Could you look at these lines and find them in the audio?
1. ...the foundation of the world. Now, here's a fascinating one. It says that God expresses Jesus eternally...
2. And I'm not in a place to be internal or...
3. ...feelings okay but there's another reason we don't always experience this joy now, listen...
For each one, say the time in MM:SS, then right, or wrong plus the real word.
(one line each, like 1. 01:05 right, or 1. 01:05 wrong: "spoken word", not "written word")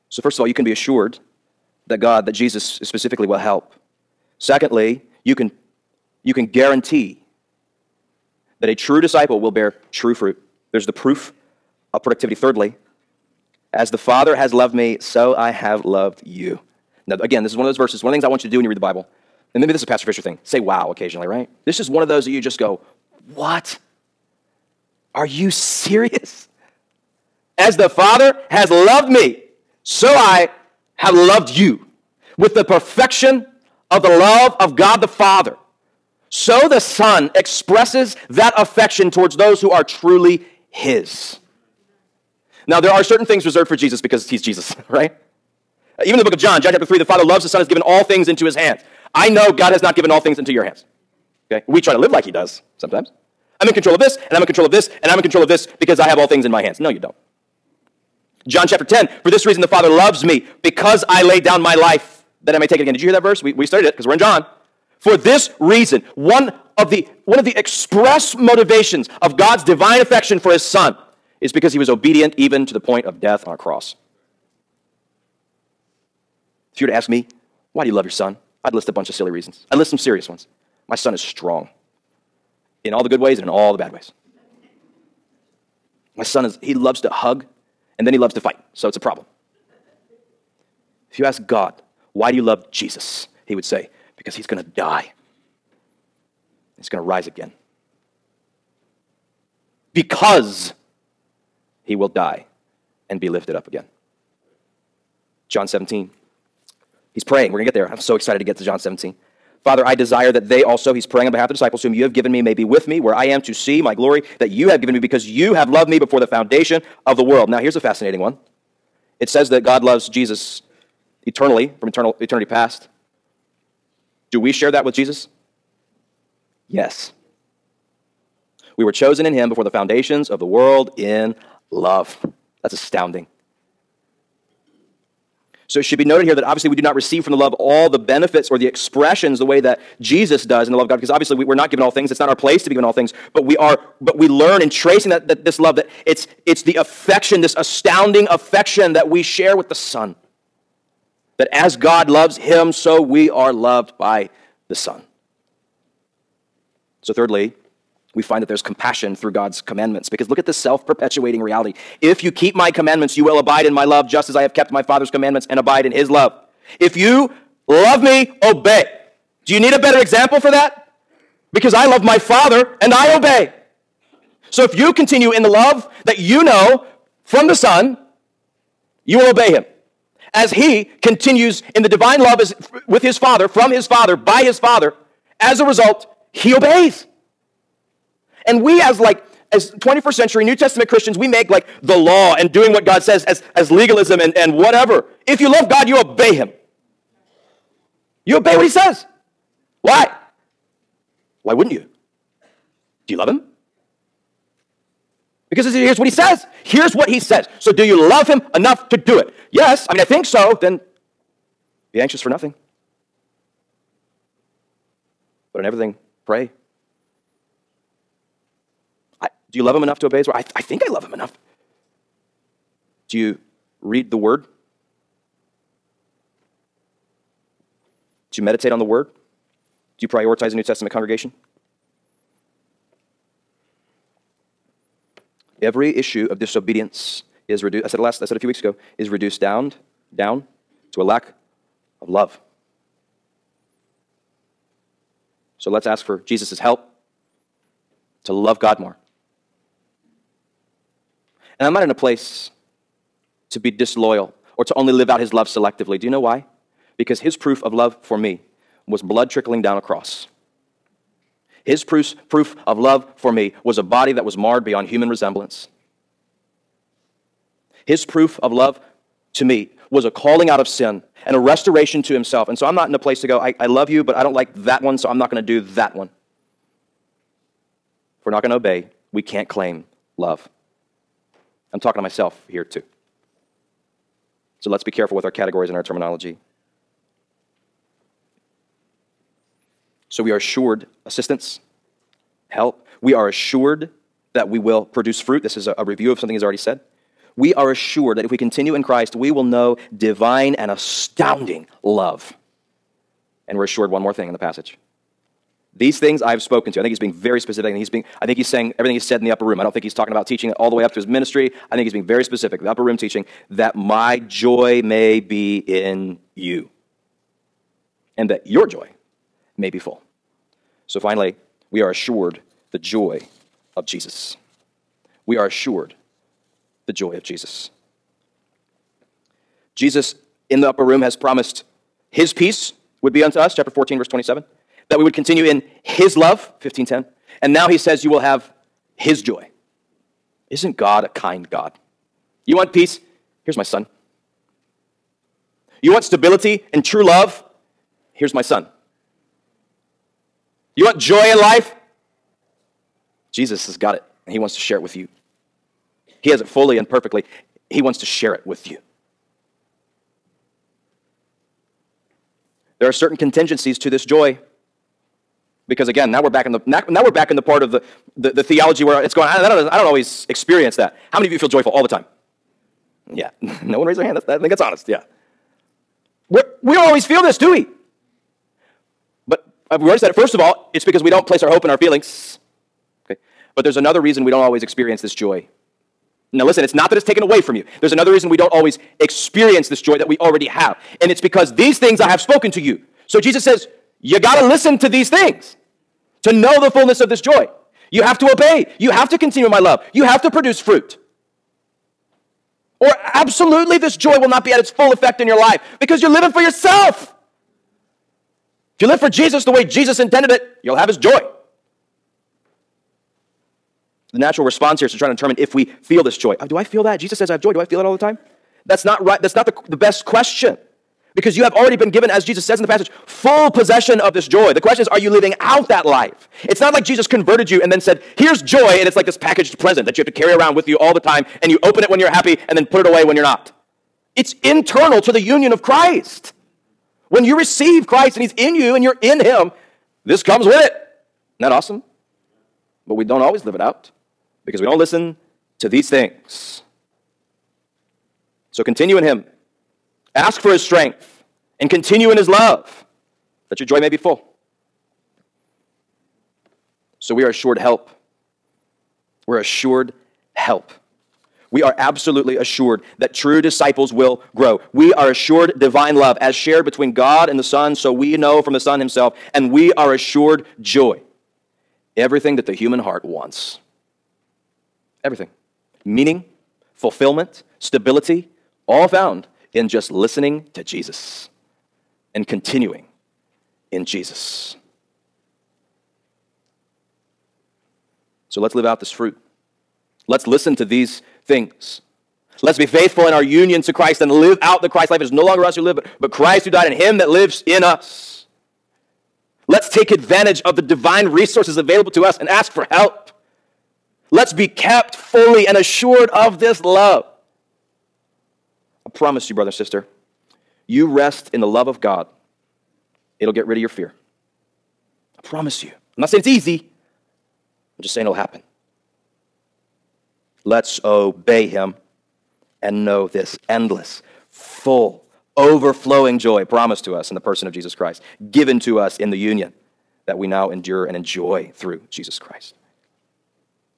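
1. 01:56 wrong: "loves", not "expresses"
2. 04:11 wrong: "disloyal", not "internal"
3. 06:21 right.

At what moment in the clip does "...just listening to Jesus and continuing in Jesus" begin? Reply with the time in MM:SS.
07:59.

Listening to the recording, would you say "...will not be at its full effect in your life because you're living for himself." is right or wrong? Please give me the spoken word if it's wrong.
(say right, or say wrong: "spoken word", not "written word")
wrong: "yourself", not "himself".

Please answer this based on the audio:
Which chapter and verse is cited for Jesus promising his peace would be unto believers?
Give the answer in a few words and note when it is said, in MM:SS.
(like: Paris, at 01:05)
Chapter 14, verse 27, at 05:33.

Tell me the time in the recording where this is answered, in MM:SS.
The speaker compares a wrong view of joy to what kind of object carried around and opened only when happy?
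07:09.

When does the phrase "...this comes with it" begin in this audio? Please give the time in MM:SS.
07:20.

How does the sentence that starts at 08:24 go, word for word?
Let's be kept fully and assured of this love.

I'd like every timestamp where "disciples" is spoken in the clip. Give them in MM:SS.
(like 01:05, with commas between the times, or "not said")
00:09, 01:51, 07:43.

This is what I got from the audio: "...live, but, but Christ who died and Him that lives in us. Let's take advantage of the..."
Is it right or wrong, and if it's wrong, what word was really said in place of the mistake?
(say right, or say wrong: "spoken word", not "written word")
right.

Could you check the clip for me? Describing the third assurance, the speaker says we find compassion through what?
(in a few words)
God's commandments.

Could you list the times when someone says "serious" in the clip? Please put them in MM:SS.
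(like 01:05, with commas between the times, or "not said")
00:25, 01:19.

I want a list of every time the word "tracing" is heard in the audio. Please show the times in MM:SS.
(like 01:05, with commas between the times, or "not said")
02:24.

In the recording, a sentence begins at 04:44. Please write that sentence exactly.
So let's be careful with our categories and our terminology.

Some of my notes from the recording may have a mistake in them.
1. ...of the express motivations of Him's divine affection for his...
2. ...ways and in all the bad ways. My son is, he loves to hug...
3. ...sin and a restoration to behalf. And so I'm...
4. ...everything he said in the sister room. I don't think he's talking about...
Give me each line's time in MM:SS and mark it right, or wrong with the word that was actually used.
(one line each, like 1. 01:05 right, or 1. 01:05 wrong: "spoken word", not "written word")
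1. 01:07 wrong: "God", not "Him"
2. 01:23 right
3. 04:30 wrong: "himself", not "behalf"
4. 05:08 wrong: "upper", not "sister".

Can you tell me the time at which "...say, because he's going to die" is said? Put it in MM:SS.
01:33.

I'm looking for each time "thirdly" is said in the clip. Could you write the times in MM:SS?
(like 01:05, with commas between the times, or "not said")
00:12, 02:37.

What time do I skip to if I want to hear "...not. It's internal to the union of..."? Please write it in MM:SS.
07:13.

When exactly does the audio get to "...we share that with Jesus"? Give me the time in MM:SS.
02:04.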